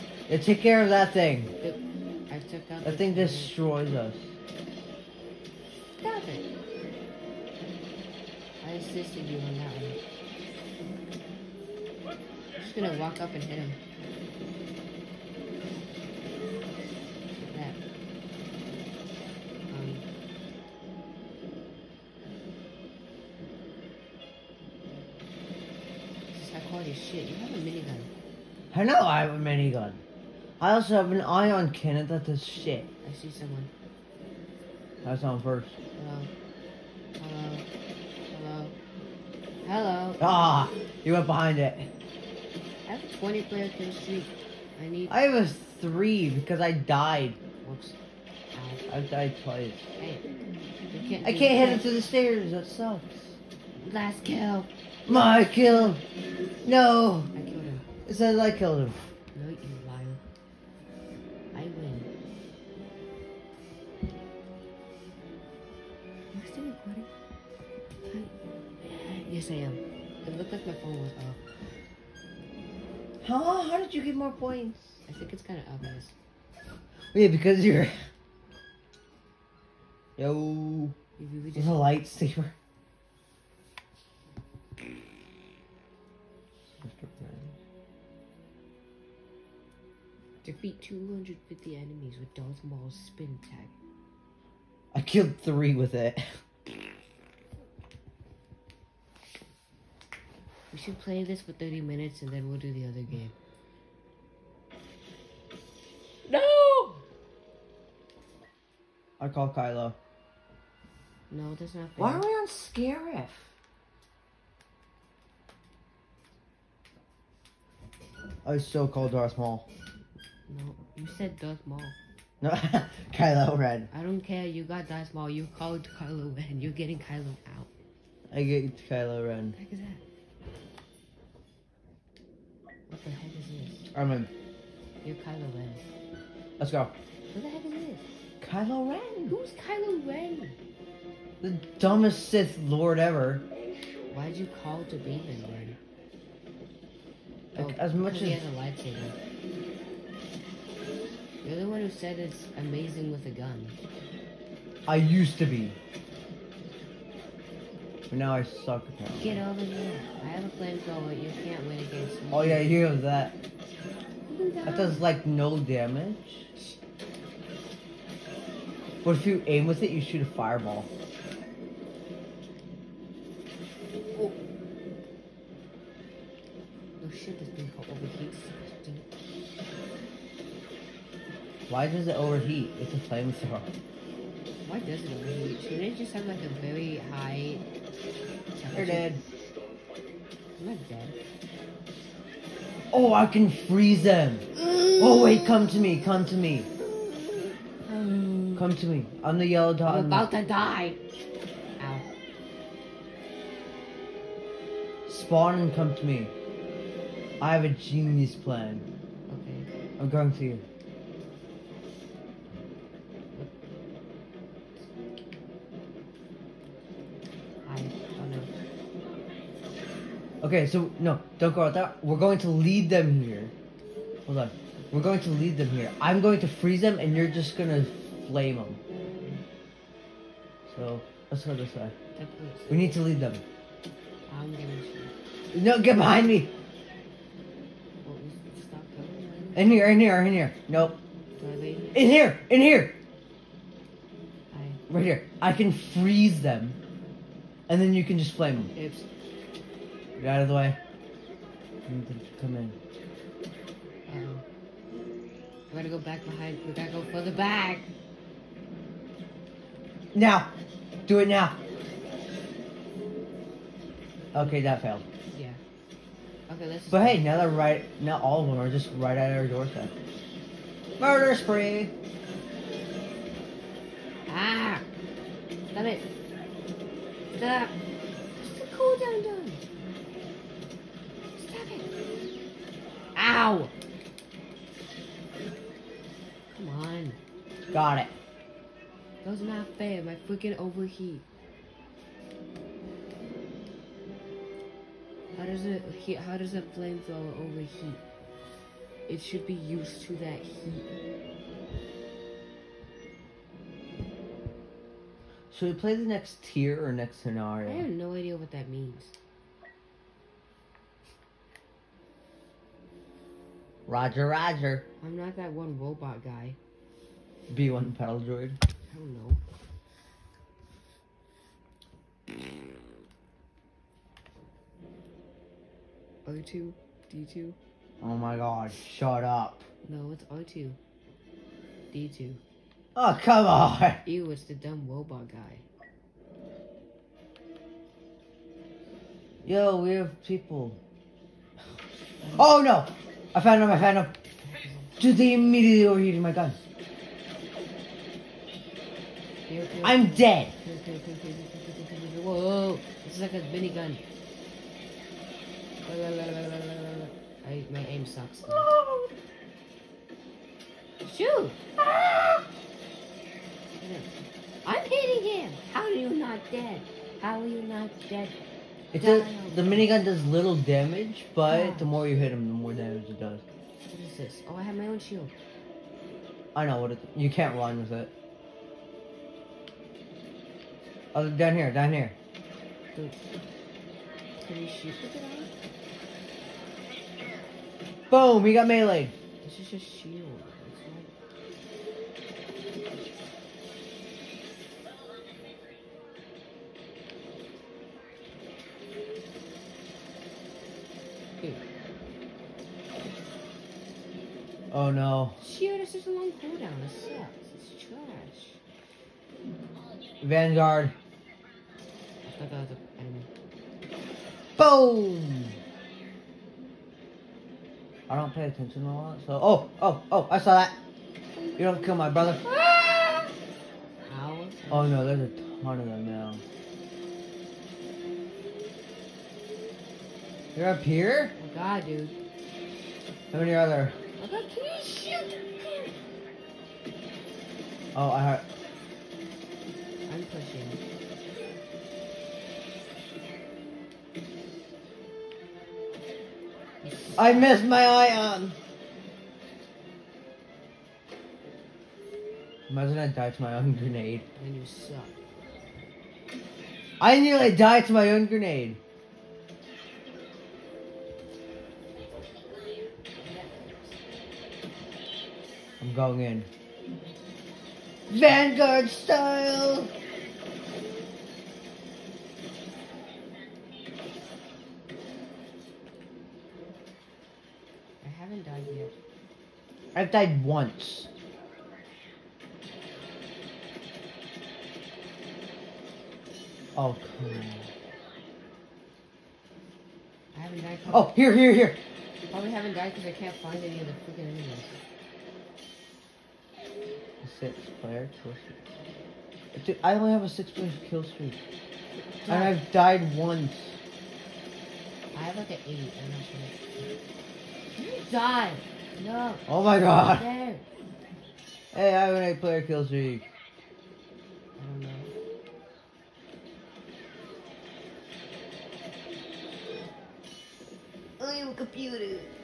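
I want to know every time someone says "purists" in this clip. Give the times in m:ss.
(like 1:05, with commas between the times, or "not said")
not said.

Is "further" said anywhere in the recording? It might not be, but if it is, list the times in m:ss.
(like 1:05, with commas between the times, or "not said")
4:17.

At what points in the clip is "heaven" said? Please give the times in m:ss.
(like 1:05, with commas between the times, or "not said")
not said.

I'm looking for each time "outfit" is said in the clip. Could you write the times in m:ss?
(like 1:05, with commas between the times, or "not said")
not said.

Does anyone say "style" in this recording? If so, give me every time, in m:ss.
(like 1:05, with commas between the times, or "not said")
7:48.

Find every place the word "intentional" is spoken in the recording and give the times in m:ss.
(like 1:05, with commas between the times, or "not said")
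not said.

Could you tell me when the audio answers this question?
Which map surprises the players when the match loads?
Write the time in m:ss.
1:52.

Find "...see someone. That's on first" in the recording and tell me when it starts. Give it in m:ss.
0:33.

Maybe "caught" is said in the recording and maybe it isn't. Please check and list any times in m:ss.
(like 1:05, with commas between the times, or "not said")
not said.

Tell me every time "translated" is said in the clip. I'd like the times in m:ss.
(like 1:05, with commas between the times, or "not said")
not said.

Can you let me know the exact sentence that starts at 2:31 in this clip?
You're the one who said it's amazing with a gun.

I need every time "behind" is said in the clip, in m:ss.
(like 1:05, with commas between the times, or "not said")
0:41, 3:55, 4:16.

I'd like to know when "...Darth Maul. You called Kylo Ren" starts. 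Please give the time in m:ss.
2:04.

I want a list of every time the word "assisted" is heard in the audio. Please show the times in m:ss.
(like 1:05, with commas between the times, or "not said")
0:08.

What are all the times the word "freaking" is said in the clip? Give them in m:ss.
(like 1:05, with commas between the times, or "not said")
4:50, 8:13.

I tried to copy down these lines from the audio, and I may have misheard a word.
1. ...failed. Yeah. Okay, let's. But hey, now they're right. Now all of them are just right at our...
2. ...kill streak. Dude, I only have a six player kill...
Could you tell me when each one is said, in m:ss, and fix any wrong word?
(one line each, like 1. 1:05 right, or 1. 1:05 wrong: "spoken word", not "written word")
1. 4:24 right
2. 8:18 right.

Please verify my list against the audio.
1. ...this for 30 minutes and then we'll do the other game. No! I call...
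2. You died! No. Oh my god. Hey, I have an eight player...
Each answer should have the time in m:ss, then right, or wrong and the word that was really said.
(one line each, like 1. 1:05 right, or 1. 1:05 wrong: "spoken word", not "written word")
1. 1:41 right
2. 8:27 right.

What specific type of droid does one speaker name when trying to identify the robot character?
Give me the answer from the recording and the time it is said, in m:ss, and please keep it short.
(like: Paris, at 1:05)
B1 battle droid, at 5:17.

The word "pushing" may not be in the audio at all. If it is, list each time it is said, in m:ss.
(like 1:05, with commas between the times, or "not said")
7:20.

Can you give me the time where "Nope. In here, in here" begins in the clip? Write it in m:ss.
4:00.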